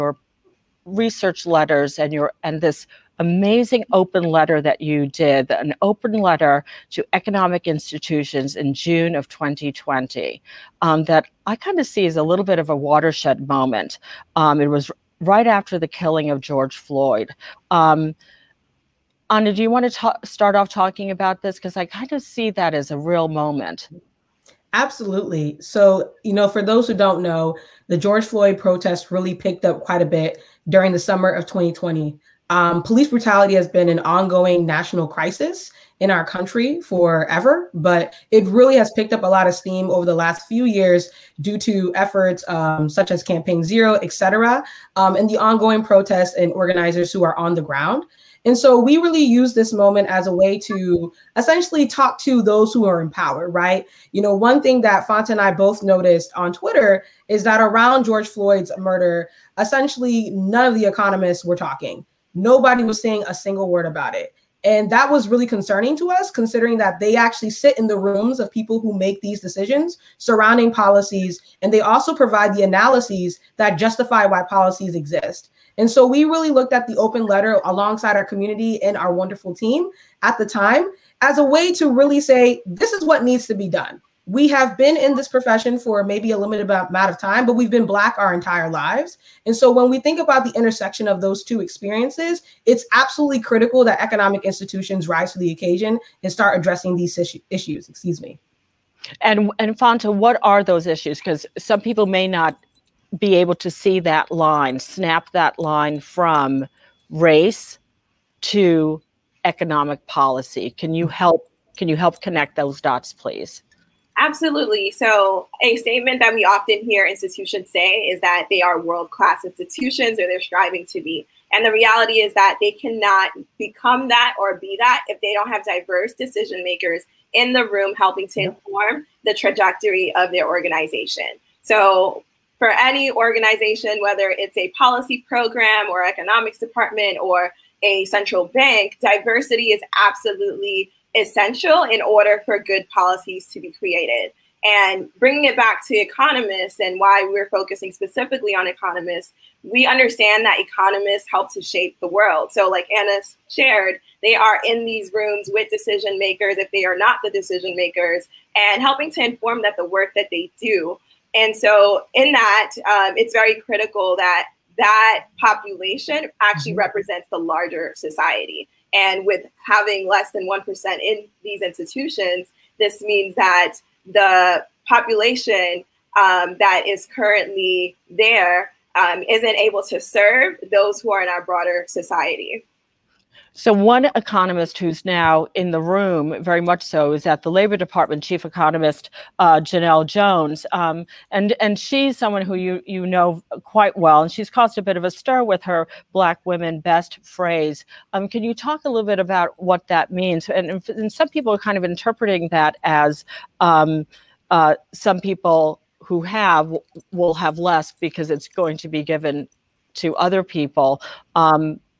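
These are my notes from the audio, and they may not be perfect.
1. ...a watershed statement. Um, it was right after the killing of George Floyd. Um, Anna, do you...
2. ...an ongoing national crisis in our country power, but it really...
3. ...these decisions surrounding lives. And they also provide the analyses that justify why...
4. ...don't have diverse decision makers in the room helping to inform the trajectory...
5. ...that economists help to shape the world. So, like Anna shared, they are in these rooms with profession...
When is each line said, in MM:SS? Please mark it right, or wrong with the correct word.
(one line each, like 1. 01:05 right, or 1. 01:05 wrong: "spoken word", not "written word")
1. 00:12 wrong: "moment", not "statement"
2. 00:33 wrong: "forever", not "power"
3. 01:09 wrong: "policies", not "lives"
4. 02:05 right
5. 02:30 wrong: "decision", not "profession".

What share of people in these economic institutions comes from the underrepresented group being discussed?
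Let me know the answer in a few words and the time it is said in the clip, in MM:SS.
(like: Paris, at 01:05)
less than 1%, at 02:50.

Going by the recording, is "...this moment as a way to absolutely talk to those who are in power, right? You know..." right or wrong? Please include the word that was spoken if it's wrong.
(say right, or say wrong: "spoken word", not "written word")
wrong: "essentially", not "absolutely".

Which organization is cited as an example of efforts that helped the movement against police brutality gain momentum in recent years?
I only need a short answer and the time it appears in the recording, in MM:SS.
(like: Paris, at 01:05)
Campaign Zero, at 00:43.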